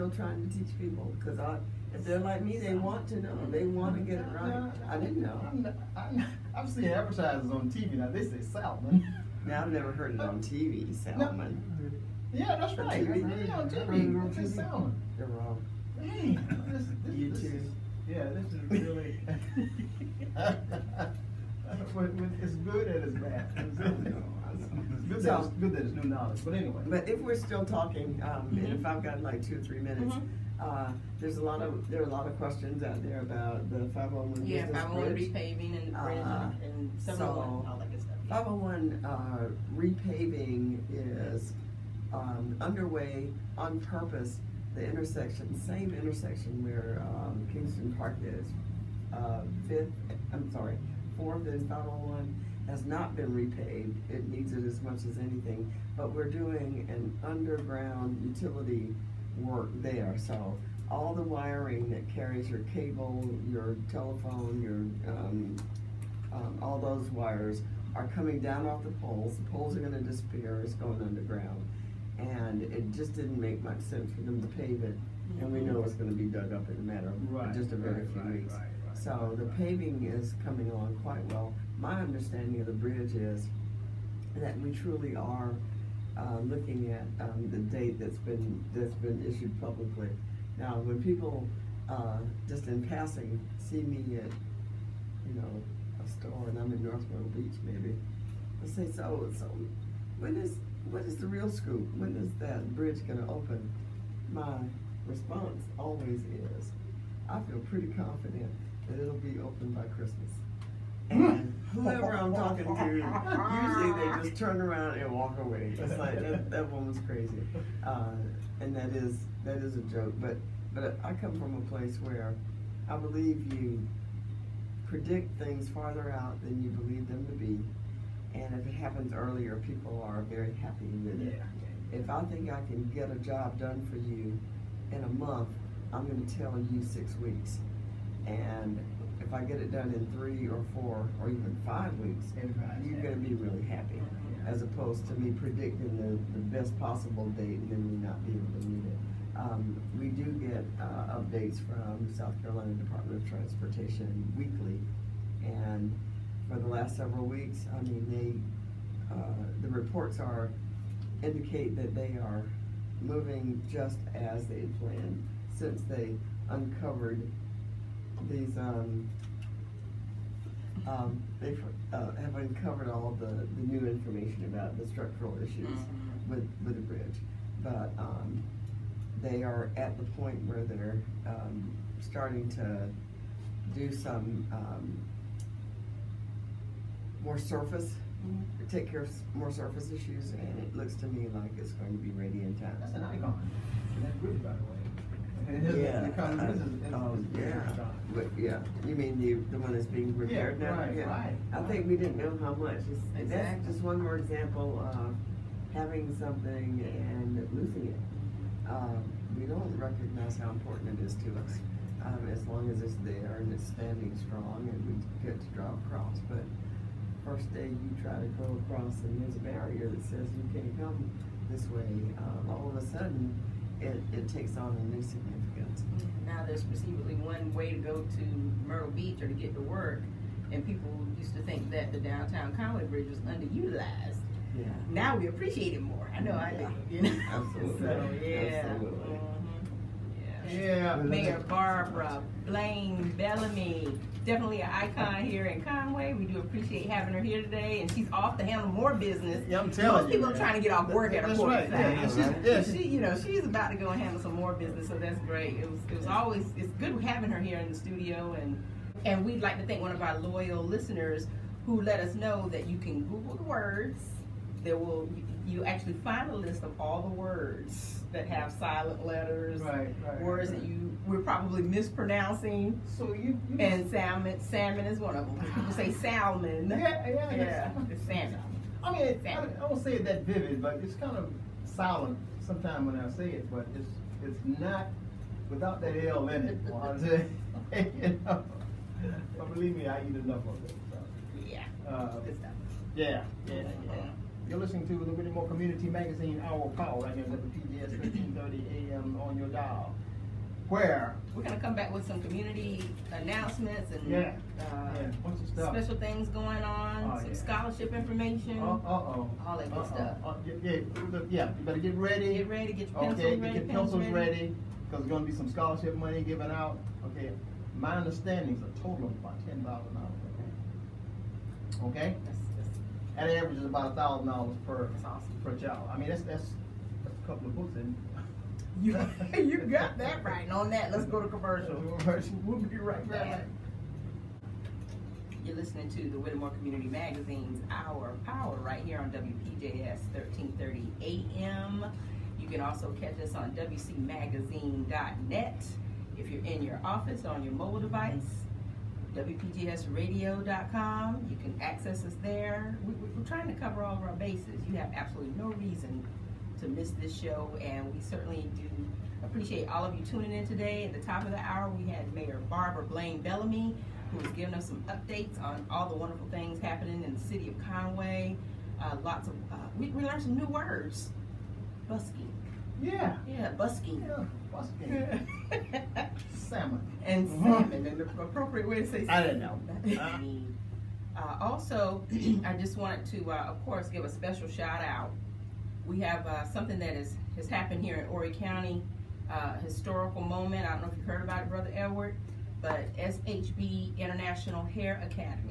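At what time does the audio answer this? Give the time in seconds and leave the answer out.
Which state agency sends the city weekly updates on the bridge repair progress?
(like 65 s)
152 s.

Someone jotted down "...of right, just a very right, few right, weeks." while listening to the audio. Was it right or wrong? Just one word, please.
right.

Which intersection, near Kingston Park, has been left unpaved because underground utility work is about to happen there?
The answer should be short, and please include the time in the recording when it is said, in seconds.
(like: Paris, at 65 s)
Fourth and 501, at 51 s.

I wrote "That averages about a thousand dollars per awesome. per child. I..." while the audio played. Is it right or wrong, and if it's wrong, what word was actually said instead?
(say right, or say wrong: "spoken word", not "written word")
right.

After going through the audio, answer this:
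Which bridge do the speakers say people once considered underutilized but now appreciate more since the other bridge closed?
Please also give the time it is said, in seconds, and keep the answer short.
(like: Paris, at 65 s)
Downtown Conway Bridge, at 231 s.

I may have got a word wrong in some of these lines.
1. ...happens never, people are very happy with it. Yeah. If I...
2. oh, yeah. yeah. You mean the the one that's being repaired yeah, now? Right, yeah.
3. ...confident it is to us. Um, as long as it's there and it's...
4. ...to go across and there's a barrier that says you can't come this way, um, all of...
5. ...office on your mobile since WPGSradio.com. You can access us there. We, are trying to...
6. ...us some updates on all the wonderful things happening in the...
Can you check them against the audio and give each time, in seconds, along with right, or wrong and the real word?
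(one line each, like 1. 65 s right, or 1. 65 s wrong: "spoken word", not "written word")
1. 128 s wrong: "earlier", not "never"
2. 196 s right
3. 210 s wrong: "important", not "confident"
4. 218 s right
5. 346 s wrong: "device", not "since"
6. 364 s right.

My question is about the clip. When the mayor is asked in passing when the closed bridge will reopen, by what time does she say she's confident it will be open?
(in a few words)
By Christmas.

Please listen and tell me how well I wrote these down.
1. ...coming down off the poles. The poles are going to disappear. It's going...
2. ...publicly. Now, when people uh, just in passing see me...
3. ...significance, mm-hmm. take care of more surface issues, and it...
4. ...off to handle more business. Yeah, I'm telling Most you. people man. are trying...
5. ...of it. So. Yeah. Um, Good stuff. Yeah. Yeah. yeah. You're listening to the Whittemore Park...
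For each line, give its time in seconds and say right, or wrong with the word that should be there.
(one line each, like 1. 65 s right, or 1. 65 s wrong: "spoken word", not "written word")
1. 68 s right
2. 89 s right
3. 187 s wrong: "surface", not "significance"
4. 248 s right
5. 290 s wrong: "Community", not "Park".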